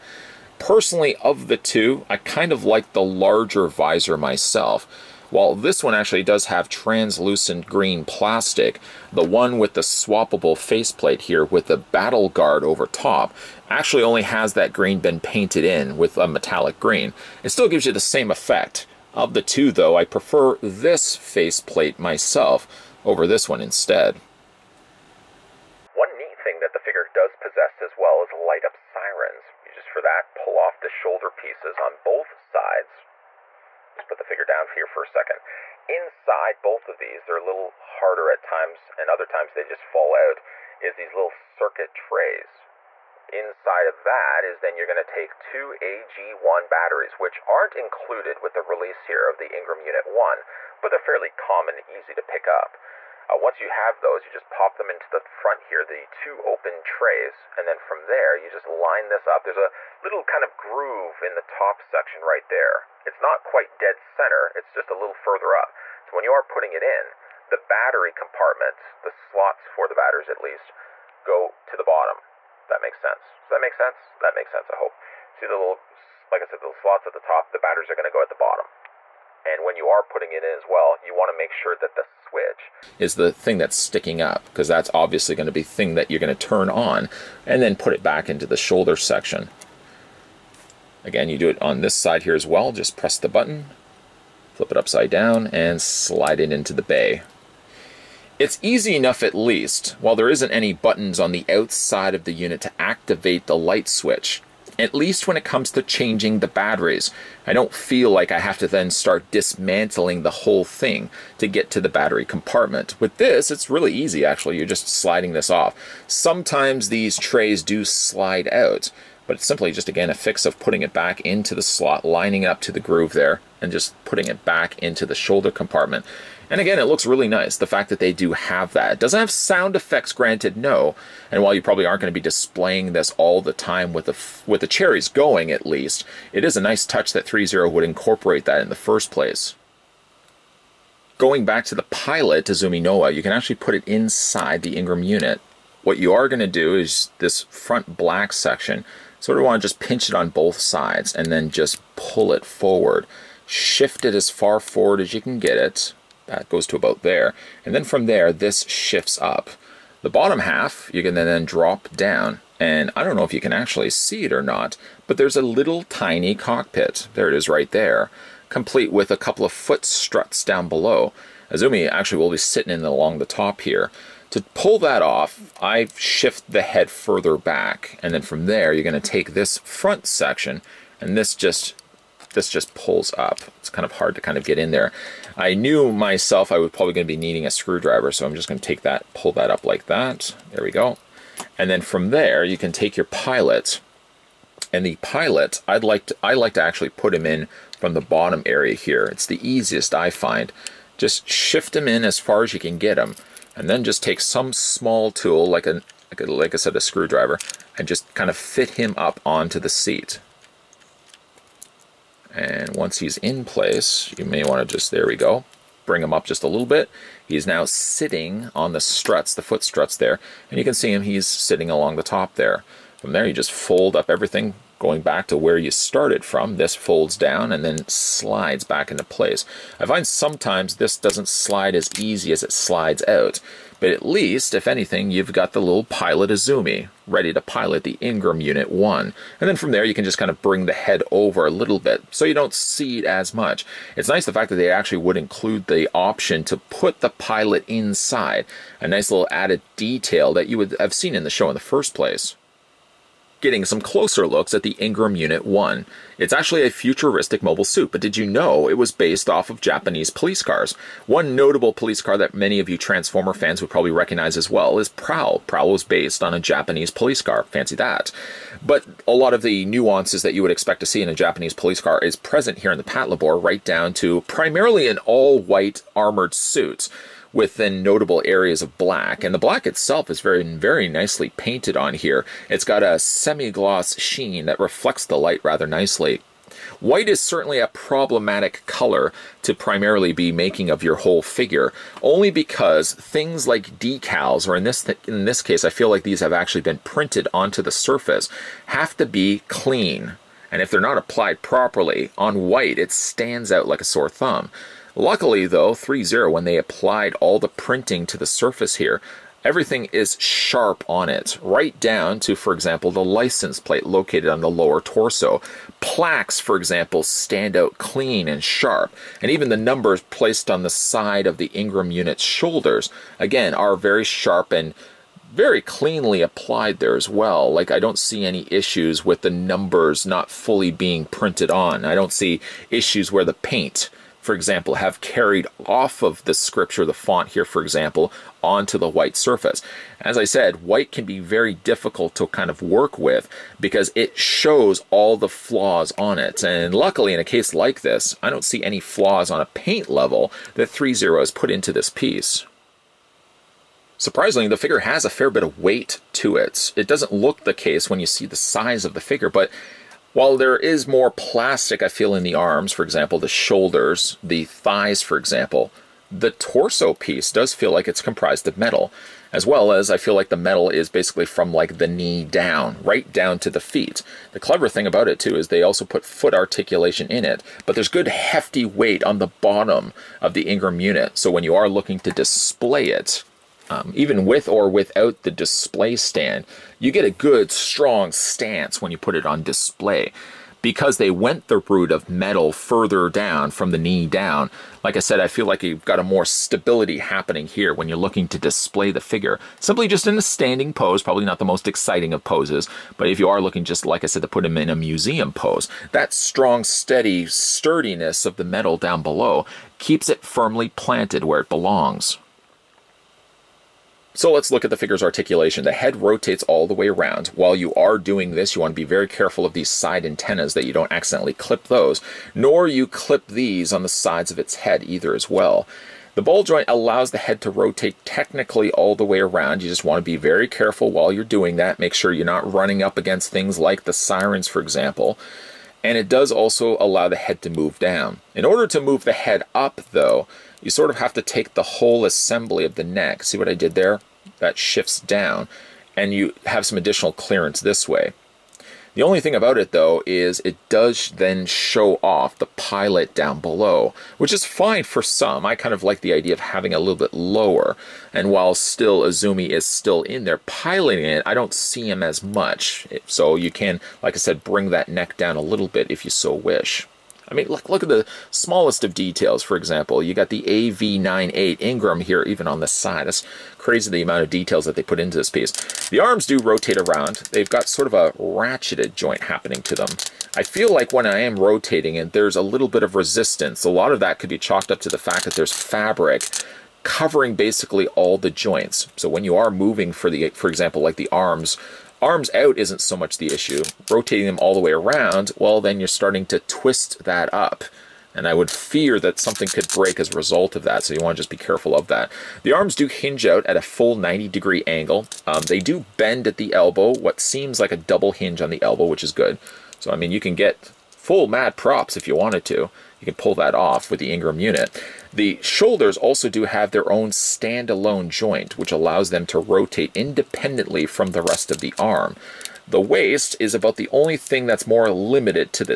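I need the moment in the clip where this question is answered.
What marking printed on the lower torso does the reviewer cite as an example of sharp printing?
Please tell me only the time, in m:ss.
5:13.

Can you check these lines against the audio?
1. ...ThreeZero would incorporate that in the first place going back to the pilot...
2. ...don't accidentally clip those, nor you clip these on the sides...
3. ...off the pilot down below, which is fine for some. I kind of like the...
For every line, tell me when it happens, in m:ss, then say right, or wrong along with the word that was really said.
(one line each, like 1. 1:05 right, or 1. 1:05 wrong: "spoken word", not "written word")
1. 2:17 right
2. 7:00 right
3. 7:32 right.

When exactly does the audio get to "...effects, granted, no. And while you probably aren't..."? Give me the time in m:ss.
2:09.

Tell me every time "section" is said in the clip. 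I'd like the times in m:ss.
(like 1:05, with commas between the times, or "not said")
1:01, 1:28, 2:28, 3:00.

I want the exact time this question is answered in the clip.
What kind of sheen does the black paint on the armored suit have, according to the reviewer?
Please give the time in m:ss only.
4:42.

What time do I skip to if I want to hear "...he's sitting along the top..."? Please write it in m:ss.
3:41.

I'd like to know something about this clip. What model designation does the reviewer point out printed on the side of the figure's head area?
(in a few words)
AV98 Ingram.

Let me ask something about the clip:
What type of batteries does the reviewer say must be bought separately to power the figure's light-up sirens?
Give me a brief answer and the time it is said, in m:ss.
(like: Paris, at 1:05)
AG1, at 0:45.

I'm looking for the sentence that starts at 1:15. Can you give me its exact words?
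See the little, like I said, the slots at the top, the batteries are going to go at the bottom.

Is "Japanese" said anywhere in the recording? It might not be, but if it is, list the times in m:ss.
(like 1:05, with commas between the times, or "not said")
4:19, 4:26, 4:31.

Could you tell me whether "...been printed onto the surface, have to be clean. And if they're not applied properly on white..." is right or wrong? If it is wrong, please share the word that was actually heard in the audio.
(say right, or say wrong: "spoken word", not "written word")
right.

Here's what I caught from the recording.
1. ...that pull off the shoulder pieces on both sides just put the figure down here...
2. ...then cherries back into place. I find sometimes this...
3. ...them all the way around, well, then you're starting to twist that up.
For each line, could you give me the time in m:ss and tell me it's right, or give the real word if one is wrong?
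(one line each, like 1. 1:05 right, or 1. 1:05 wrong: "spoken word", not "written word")
1. 0:30 right
2. 3:47 wrong: "slides", not "cherries"
3. 8:14 right.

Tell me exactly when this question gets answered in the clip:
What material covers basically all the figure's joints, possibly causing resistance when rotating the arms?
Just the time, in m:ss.
8:05.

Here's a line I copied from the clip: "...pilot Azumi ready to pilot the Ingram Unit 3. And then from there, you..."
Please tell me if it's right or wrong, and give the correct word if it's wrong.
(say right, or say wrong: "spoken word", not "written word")
wrong: "1", not "3".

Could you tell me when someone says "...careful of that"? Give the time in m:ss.
8:21.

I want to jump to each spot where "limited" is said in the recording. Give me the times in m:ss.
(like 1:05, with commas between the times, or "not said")
8:44.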